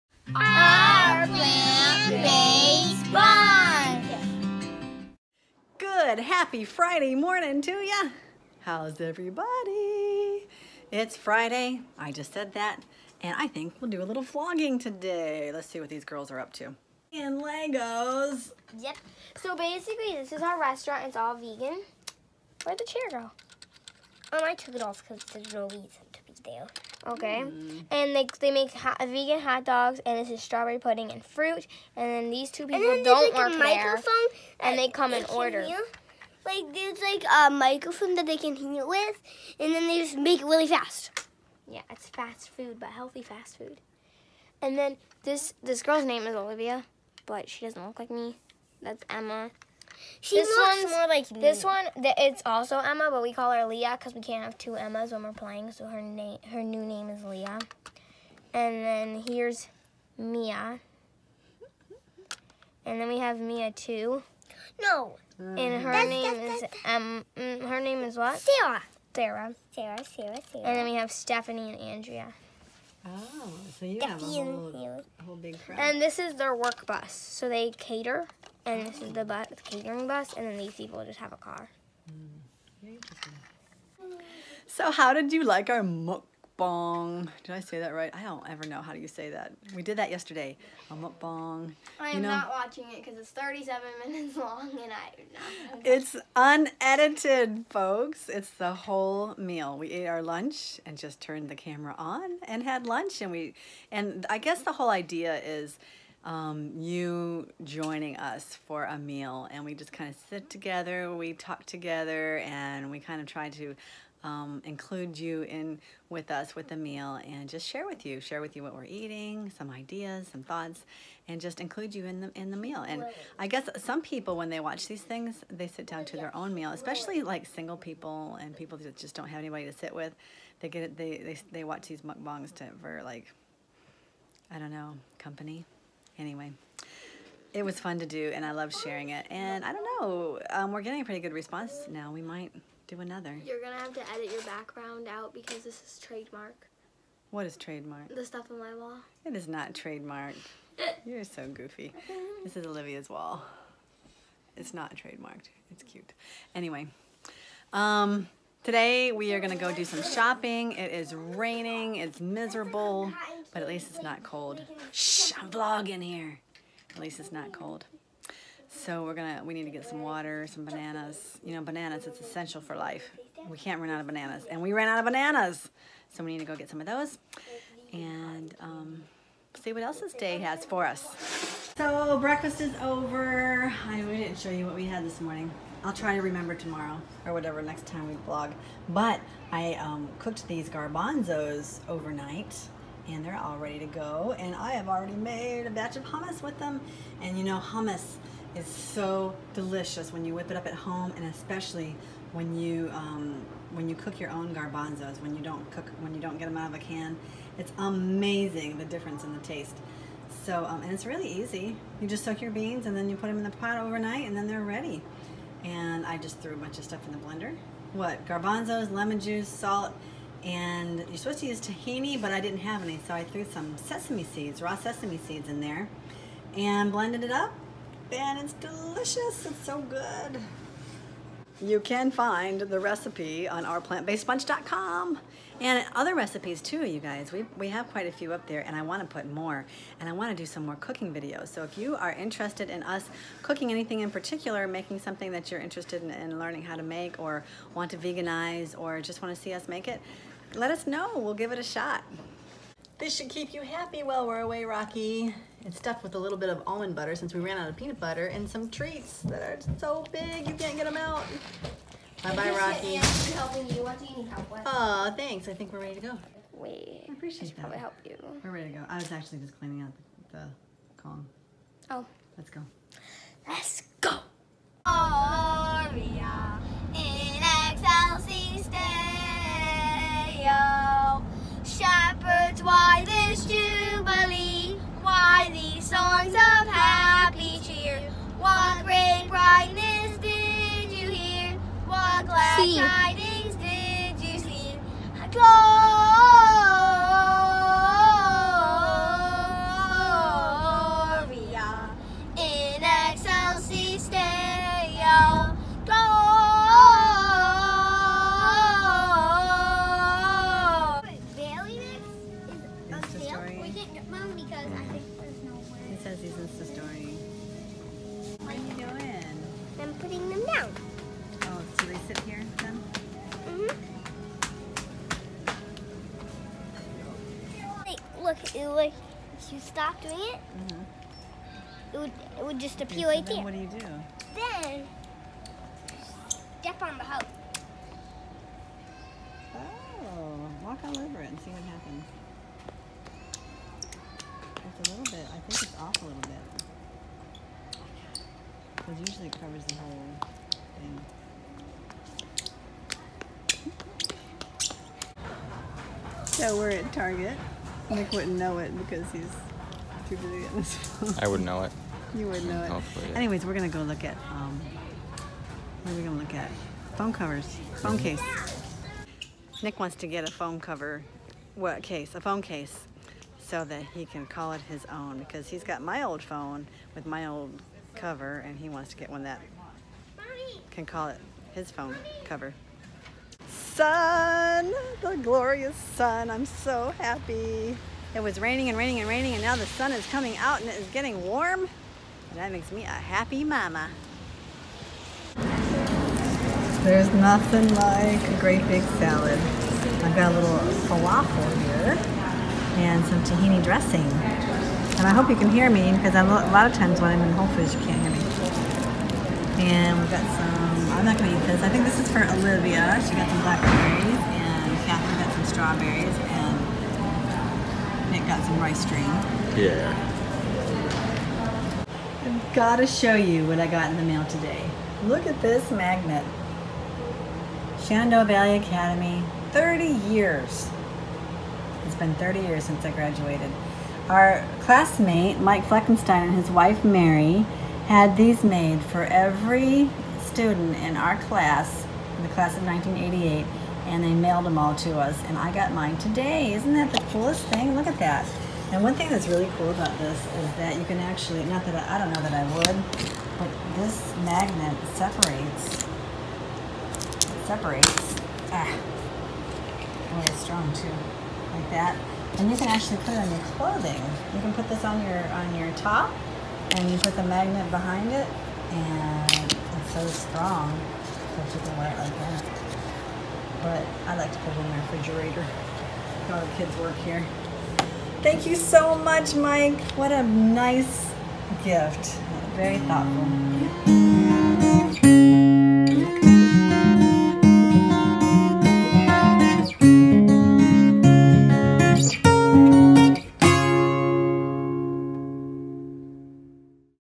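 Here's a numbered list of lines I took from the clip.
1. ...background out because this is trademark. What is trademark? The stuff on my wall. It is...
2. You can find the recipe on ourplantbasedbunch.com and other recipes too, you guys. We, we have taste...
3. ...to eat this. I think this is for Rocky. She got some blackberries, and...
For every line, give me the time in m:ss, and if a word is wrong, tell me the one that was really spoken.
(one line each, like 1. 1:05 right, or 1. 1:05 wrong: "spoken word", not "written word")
1. 2:24 right
2. 3:51 wrong: "quite", not "taste"
3. 6:51 wrong: "Olivia", not "Rocky".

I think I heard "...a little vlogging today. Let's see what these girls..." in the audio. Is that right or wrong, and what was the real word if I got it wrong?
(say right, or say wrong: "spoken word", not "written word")
right.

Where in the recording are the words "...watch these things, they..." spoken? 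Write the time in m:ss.
2:04.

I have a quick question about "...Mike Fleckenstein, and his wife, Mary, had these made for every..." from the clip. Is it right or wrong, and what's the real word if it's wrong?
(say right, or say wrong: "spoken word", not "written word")
right.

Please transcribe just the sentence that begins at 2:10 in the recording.
They get they they they watch these mukbangs to for like I don't know company.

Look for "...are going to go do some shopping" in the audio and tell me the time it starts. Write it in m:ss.
2:39.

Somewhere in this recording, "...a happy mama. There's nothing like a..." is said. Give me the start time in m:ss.
6:32.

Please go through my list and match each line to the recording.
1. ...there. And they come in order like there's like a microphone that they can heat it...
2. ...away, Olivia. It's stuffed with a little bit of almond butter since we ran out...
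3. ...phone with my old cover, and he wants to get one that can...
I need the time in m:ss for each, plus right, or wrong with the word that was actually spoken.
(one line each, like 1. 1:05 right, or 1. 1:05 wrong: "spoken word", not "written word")
1. 0:34 right
2. 4:14 wrong: "Rocky", not "Olivia"
3. 6:16 right.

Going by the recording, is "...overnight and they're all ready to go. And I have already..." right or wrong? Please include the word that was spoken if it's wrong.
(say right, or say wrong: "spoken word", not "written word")
right.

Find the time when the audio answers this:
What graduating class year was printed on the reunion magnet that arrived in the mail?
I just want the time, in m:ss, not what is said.
7:22.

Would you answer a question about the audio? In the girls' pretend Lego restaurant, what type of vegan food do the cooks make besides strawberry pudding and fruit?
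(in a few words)
hot dogs.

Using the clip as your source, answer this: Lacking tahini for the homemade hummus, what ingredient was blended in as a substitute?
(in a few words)
raw sesame seeds.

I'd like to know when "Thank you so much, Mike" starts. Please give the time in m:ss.
7:58.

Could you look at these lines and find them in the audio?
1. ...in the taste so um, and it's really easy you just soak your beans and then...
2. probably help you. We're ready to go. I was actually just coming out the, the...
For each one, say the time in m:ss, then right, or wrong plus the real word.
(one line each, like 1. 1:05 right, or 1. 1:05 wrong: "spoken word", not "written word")
1. 3:29 right
2. 4:27 wrong: "cleaning", not "coming".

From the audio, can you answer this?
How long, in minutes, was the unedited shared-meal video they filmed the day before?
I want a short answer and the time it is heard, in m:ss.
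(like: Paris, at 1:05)
37, at 1:33.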